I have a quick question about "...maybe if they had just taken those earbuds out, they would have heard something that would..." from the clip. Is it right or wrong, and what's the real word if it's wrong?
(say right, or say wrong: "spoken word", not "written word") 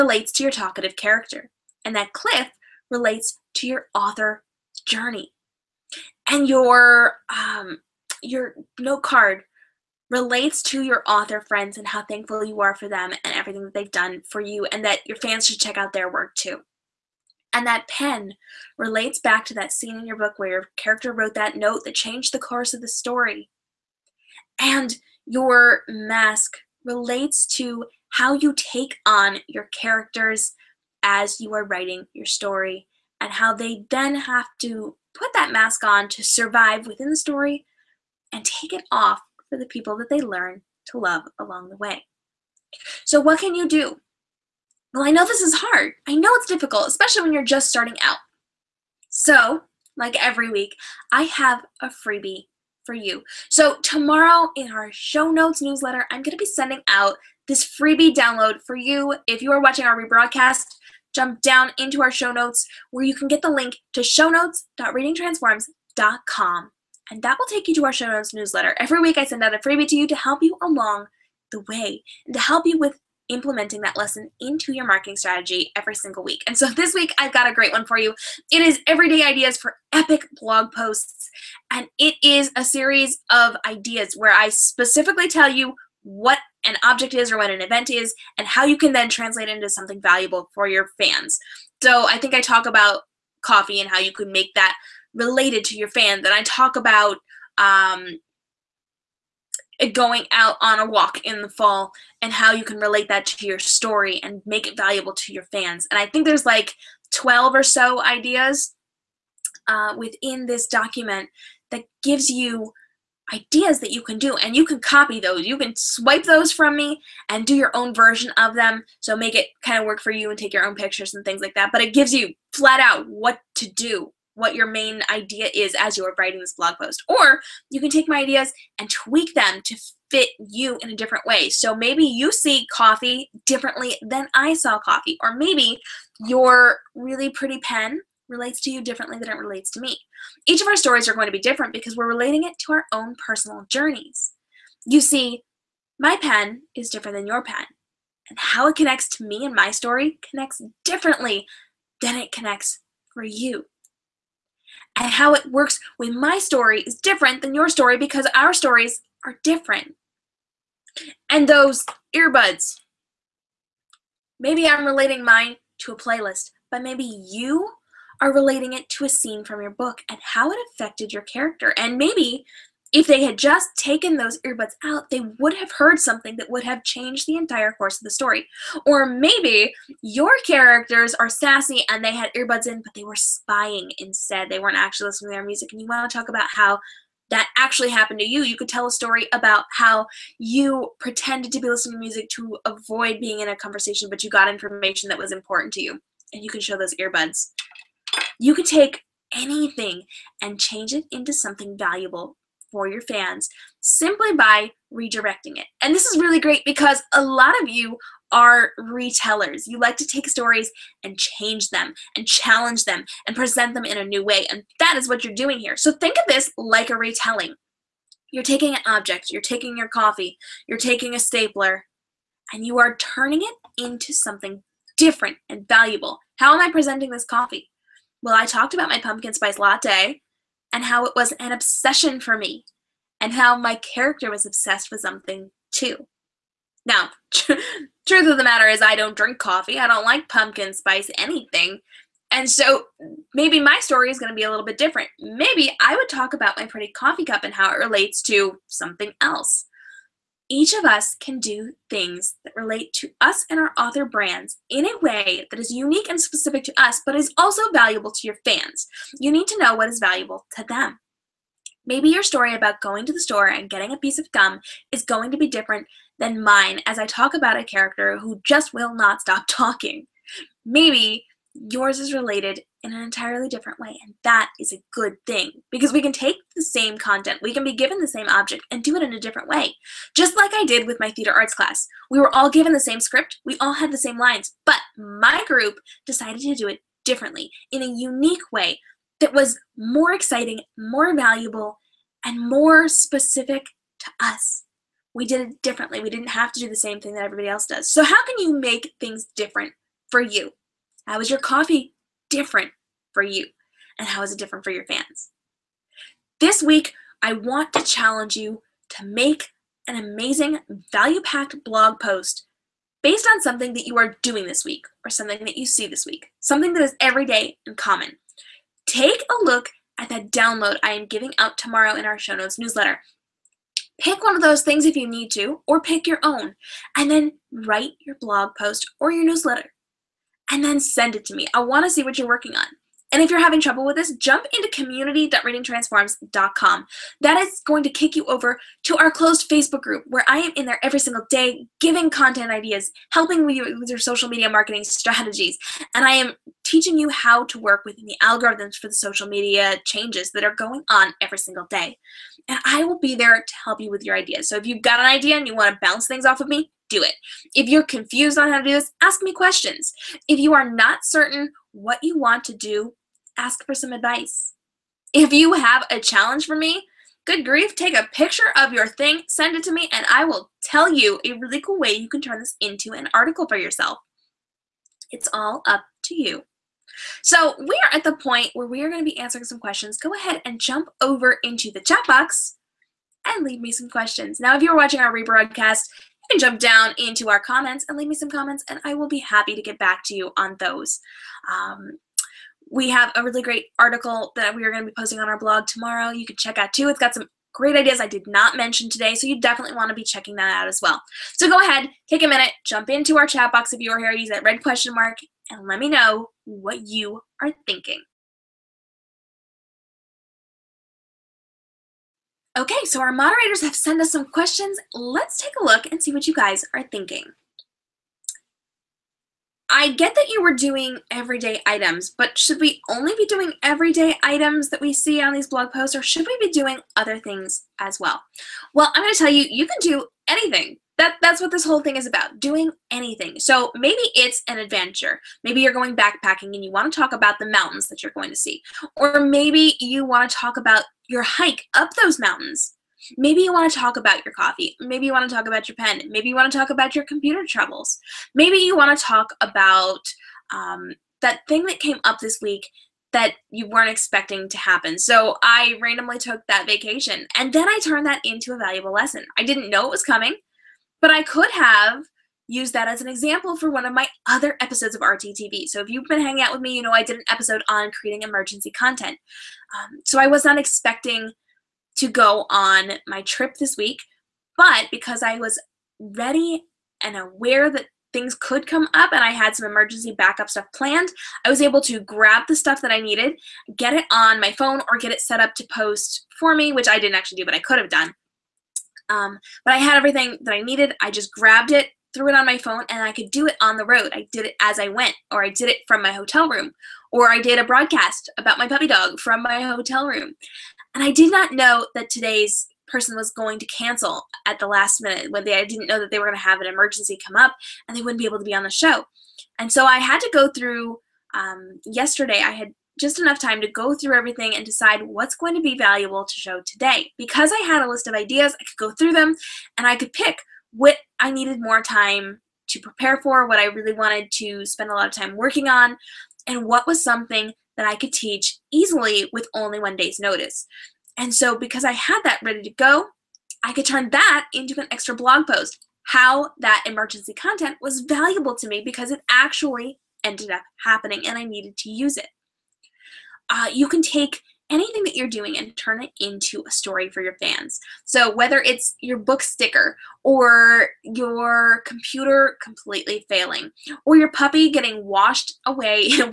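right.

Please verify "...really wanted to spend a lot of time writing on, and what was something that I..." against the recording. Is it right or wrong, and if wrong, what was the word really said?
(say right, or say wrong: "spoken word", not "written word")
wrong: "working", not "writing".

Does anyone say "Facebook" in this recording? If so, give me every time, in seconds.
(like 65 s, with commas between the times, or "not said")
339 s.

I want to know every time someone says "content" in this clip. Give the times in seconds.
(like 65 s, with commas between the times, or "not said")
276 s, 342 s, 468 s, 537 s.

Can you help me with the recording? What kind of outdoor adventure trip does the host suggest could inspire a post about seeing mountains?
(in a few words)
backpacking.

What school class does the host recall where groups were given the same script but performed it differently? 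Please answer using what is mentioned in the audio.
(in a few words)
theater arts class.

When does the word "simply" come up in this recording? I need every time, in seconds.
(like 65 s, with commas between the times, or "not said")
203 s.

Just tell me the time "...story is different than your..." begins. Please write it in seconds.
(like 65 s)
156 s.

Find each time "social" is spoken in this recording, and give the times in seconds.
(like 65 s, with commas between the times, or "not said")
343 s, 348 s.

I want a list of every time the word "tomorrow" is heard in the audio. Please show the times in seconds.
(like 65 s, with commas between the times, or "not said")
53 s, 321 s, 395 s.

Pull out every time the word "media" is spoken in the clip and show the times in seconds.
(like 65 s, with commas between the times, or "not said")
344 s, 349 s.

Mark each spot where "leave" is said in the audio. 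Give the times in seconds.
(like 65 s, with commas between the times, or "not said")
383 s, 387 s.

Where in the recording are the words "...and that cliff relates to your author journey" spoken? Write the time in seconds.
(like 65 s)
1 s.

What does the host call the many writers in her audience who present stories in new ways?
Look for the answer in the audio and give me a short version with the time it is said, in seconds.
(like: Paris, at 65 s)
retellers, at 208 s.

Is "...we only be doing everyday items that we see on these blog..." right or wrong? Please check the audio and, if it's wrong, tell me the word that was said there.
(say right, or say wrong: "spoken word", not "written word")
right.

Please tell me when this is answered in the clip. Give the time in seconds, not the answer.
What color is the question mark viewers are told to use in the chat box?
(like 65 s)
404 s.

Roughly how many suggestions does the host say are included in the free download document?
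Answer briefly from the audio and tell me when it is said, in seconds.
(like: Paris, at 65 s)
12, at 107 s.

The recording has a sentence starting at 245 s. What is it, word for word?
Maybe I would talk about my pretty coffee cup and how it relates to something else.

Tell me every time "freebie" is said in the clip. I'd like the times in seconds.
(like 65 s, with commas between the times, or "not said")
51 s, 57 s, 69 s.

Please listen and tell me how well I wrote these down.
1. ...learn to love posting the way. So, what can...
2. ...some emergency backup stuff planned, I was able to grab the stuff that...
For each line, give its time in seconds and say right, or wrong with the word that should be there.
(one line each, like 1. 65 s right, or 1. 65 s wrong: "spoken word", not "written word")
1. 40 s wrong: "along", not "posting"
2. 479 s right.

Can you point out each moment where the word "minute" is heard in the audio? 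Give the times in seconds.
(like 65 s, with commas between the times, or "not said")
402 s, 505 s.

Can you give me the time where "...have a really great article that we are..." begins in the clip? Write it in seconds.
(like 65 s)
392 s.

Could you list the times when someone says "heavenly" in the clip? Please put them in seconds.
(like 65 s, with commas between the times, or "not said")
not said.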